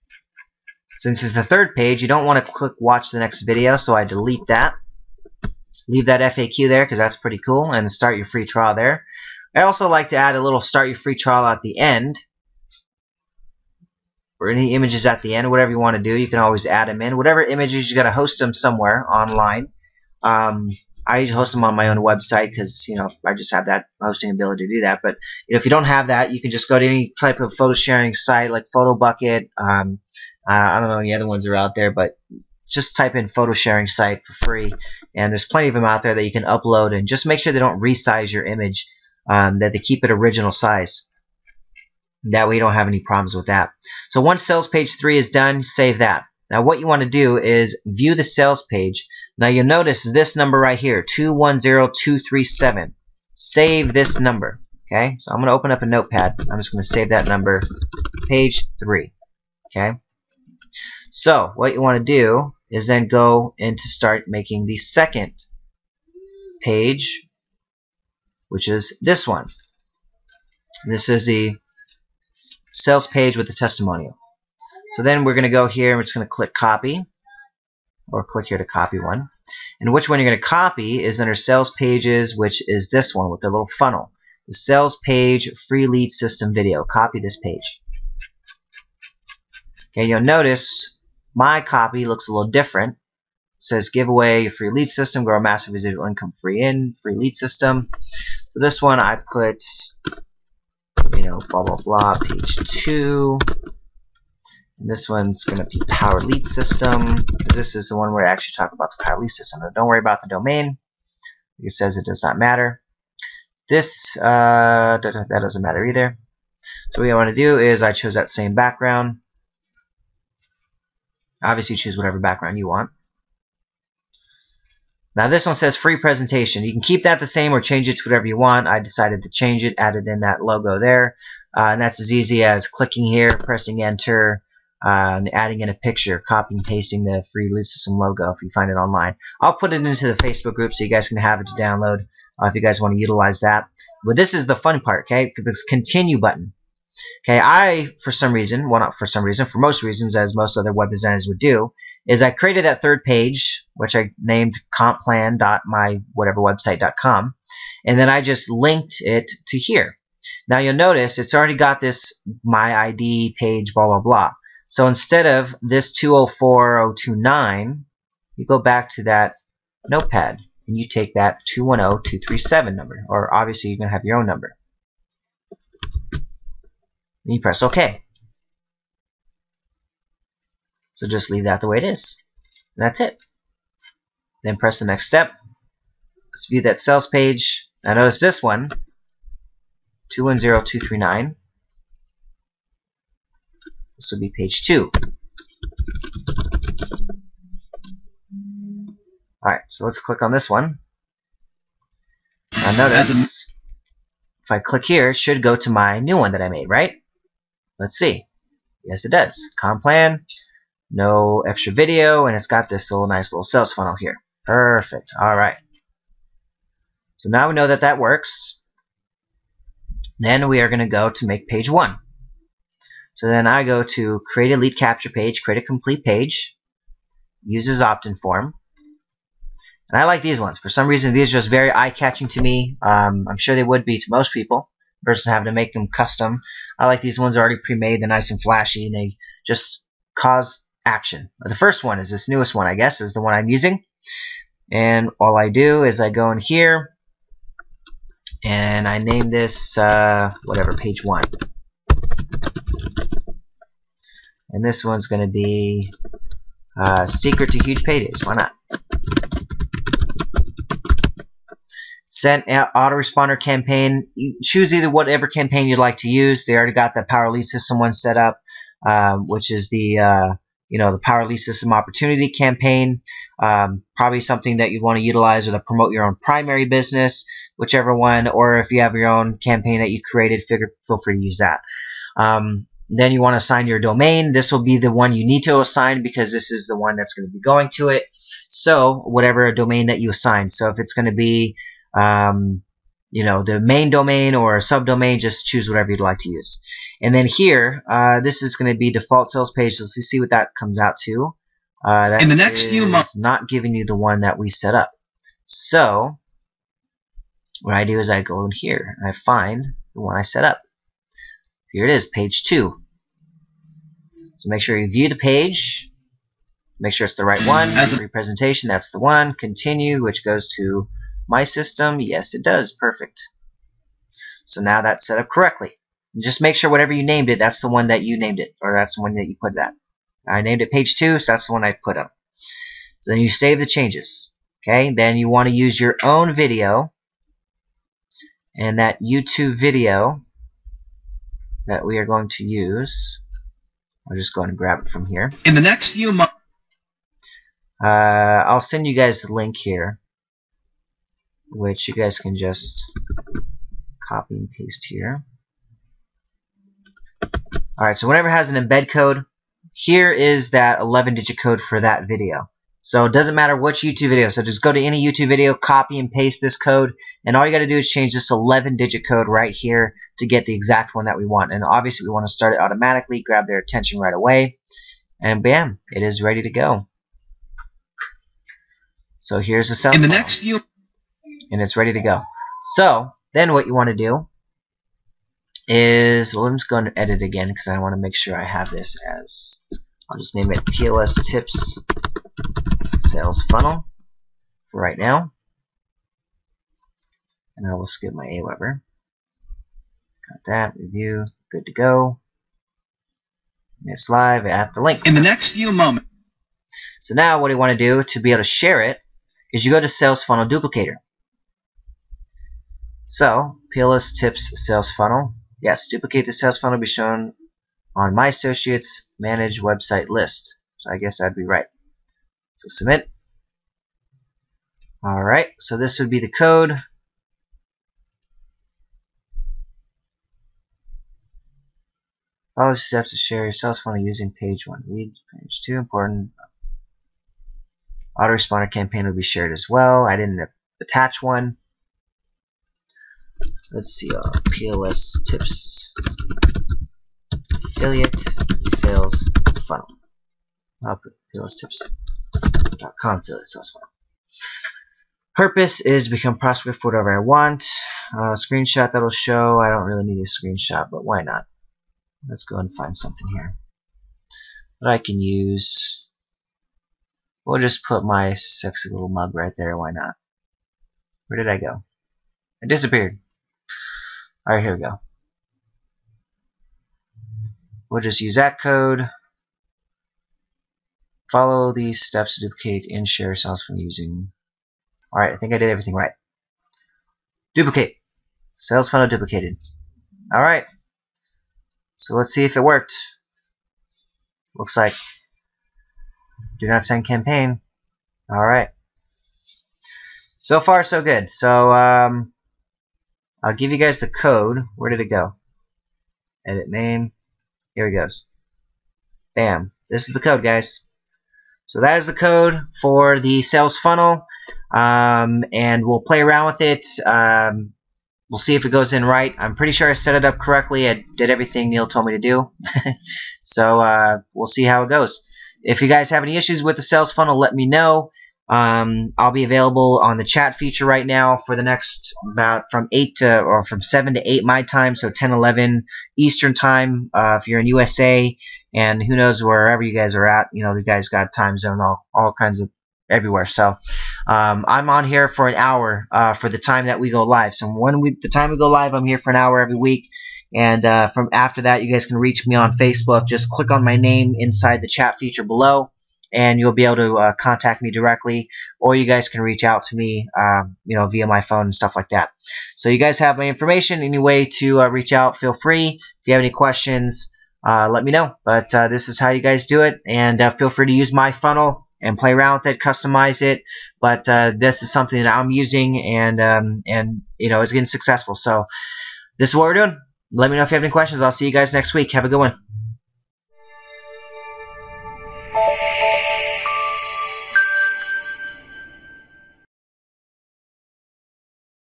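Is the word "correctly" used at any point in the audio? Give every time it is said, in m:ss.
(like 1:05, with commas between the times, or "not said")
5:25, 8:40.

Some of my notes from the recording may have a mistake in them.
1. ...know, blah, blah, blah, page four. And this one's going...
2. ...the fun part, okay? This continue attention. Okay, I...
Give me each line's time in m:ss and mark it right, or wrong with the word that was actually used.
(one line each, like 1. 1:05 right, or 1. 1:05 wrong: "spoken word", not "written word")
1. 1:41 wrong: "two", not "four"
2. 2:24 wrong: "button", not "attention".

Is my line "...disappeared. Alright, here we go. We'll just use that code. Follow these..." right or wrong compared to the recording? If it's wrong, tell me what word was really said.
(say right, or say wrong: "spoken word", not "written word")
right.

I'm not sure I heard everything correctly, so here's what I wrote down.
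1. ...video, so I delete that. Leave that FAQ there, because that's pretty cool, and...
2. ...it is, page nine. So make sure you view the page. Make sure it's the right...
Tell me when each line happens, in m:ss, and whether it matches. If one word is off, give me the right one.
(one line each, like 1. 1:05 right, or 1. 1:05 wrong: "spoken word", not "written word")
1. 0:03 right
2. 5:11 wrong: "two", not "nine".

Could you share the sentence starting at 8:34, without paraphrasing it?
Um, and we'll play around with it.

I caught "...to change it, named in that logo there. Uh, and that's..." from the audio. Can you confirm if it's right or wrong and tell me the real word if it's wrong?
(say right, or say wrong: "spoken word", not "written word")
wrong: "added", not "named".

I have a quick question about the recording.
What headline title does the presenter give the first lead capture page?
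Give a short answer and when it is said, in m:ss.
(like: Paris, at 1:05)
Secret to Huge Paydays, at 4:17.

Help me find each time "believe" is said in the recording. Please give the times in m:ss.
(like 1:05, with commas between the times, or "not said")
not said.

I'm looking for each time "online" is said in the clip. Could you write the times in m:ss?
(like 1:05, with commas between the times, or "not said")
0:19, 2:18.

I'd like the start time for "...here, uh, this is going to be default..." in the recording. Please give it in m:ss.
4:57.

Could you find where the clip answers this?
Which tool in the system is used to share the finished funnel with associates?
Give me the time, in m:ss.
6:49.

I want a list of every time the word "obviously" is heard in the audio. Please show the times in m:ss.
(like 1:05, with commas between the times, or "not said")
2:01, 2:53, 6:11.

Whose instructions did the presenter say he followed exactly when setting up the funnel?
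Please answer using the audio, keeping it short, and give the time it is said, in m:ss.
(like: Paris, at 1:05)
Neil, at 8:41.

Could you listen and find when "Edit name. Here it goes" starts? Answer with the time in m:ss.
8:26.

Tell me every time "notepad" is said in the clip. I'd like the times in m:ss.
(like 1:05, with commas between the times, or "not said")
0:55, 2:49.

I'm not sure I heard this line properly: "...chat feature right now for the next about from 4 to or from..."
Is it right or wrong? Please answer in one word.
wrong.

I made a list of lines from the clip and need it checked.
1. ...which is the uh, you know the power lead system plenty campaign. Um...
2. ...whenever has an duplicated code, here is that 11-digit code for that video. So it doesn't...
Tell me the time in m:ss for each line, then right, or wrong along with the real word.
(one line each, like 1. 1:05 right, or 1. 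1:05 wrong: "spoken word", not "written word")
1. 4:29 wrong: "opportunity", not "plenty"
2. 5:58 wrong: "embed", not "duplicated".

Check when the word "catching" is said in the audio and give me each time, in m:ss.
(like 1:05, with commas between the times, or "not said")
3:51.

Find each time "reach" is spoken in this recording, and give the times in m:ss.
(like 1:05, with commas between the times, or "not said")
9:12, 9:19, 9:24.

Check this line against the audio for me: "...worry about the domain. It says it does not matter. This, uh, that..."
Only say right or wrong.
right.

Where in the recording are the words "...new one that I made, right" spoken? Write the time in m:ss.
3:26.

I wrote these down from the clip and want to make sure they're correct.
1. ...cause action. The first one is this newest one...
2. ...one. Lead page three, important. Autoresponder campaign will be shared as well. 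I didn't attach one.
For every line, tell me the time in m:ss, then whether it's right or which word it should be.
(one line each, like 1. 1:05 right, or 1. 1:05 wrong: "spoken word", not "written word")
1. 4:00 right
2. 7:14 wrong: "two", not "three".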